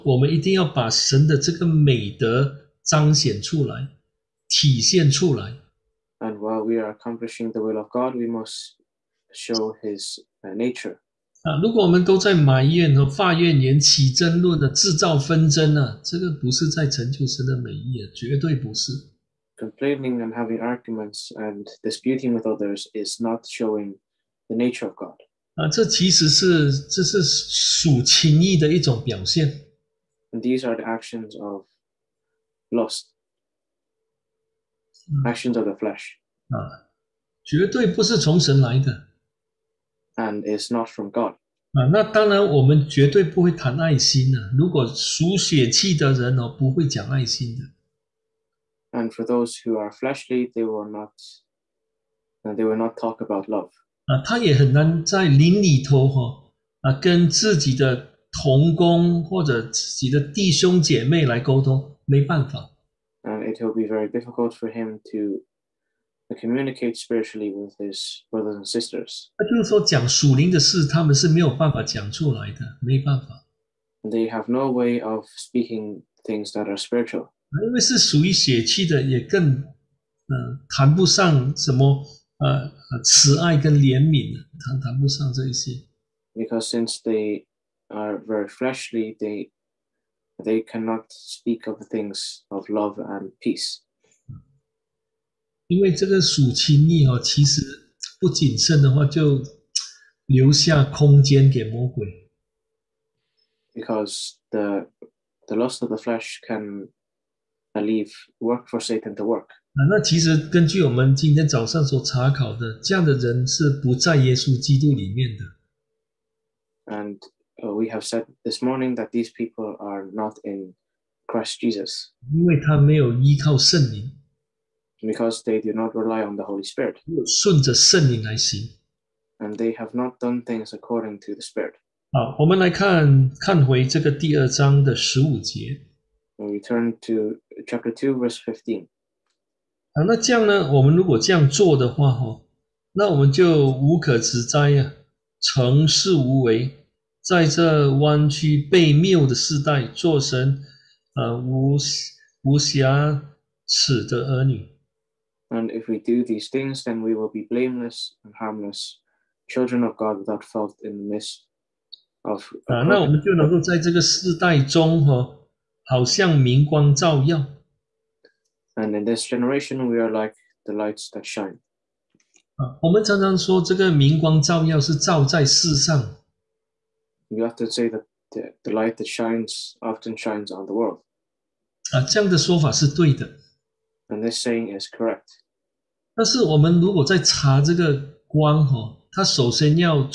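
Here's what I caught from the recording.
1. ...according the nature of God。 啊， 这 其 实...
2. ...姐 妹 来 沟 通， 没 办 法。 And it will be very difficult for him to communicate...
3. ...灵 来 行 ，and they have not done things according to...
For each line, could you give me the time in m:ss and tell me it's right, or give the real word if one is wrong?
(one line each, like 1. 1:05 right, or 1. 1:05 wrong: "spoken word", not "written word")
1. 0:23 wrong: "showing", not "according"
2. 1:00 right
3. 2:08 right.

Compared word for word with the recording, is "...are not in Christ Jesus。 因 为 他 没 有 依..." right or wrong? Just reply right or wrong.
right.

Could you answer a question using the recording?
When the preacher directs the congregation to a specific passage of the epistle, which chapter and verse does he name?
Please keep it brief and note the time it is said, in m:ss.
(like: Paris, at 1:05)
Chapter 2, verse 15, at 2:17.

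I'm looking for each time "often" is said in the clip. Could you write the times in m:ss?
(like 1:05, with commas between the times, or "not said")
2:52, 2:59.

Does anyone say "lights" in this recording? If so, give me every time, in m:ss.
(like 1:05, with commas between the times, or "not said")
2:50, 2:58.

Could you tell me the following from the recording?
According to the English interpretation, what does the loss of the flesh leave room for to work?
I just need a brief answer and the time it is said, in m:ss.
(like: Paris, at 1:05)
Satan, at 1:48.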